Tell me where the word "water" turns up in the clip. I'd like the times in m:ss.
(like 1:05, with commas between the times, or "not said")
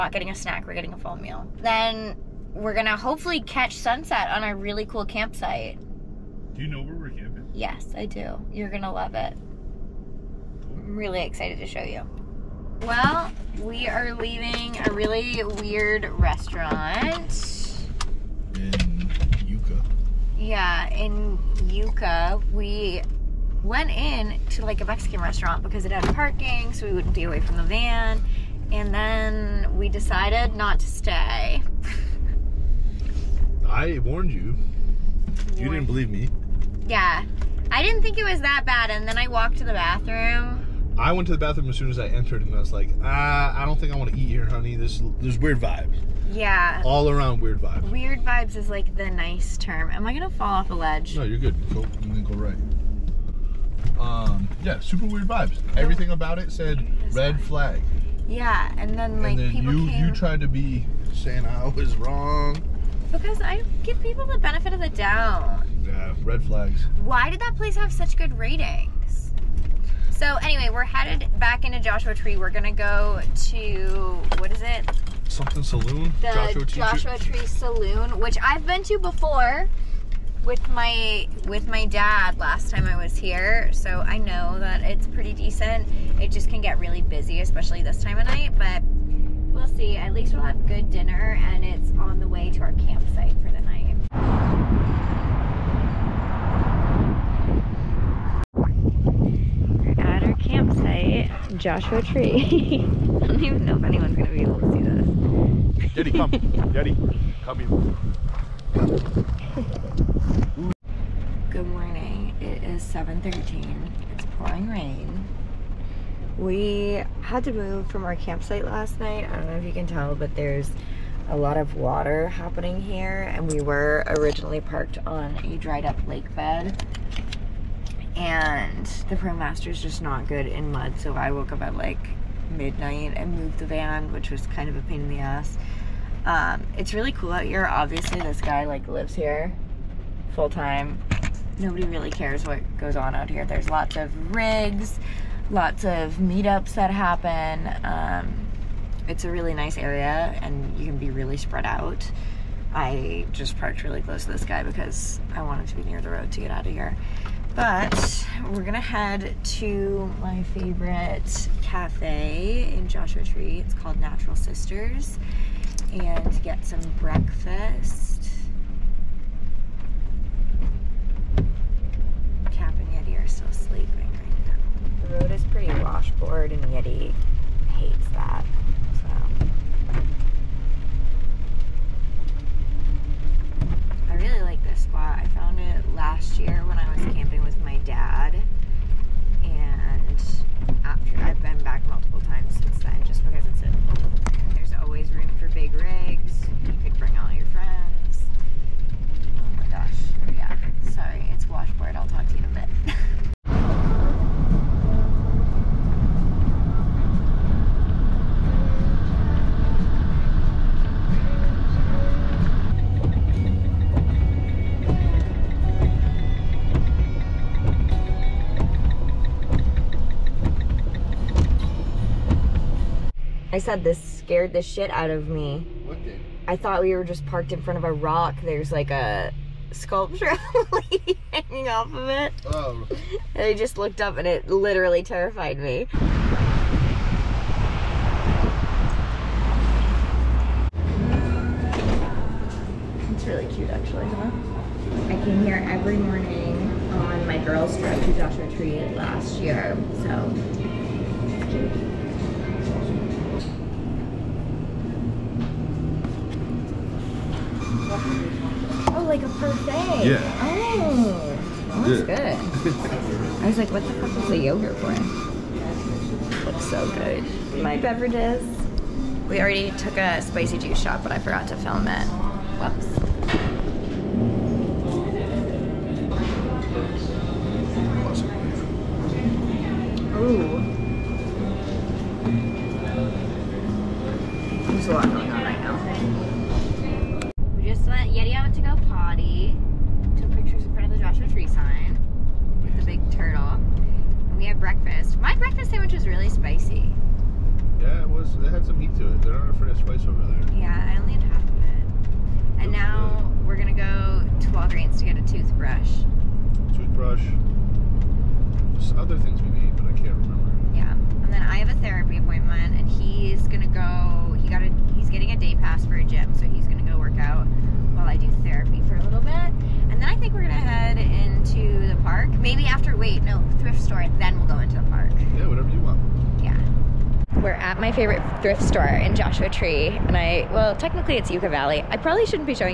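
2:01.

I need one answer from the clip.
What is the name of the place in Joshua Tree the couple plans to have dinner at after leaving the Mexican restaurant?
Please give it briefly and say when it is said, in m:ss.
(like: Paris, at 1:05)
Joshua Tree Saloon, at 1:16.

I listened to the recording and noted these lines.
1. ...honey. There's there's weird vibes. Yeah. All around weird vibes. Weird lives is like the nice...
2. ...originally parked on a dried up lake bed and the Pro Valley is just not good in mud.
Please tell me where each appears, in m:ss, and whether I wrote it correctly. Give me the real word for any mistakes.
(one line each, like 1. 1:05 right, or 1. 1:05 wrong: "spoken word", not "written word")
1. 0:44 wrong: "vibes", not "lives"
2. 2:04 wrong: "Master", not "Valley".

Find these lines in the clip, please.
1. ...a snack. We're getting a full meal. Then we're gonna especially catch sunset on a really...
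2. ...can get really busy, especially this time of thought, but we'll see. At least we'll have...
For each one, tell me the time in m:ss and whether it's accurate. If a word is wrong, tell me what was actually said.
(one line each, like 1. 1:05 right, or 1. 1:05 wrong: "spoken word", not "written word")
1. 0:00 wrong: "hopefully", not "especially"
2. 1:26 wrong: "night", not "thought".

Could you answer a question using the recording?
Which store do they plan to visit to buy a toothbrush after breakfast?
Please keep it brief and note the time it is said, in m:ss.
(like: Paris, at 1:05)
Walgreens, at 5:04.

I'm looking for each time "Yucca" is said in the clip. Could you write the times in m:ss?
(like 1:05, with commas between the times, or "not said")
0:21, 5:31.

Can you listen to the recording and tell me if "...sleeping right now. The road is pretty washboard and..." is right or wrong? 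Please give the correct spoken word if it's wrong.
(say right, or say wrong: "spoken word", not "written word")
right.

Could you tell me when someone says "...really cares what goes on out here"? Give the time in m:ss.
2:21.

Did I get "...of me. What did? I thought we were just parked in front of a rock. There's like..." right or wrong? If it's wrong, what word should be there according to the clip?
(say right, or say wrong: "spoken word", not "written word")
right.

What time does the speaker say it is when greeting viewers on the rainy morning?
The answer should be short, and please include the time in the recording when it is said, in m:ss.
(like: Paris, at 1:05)
7:13, at 1:52.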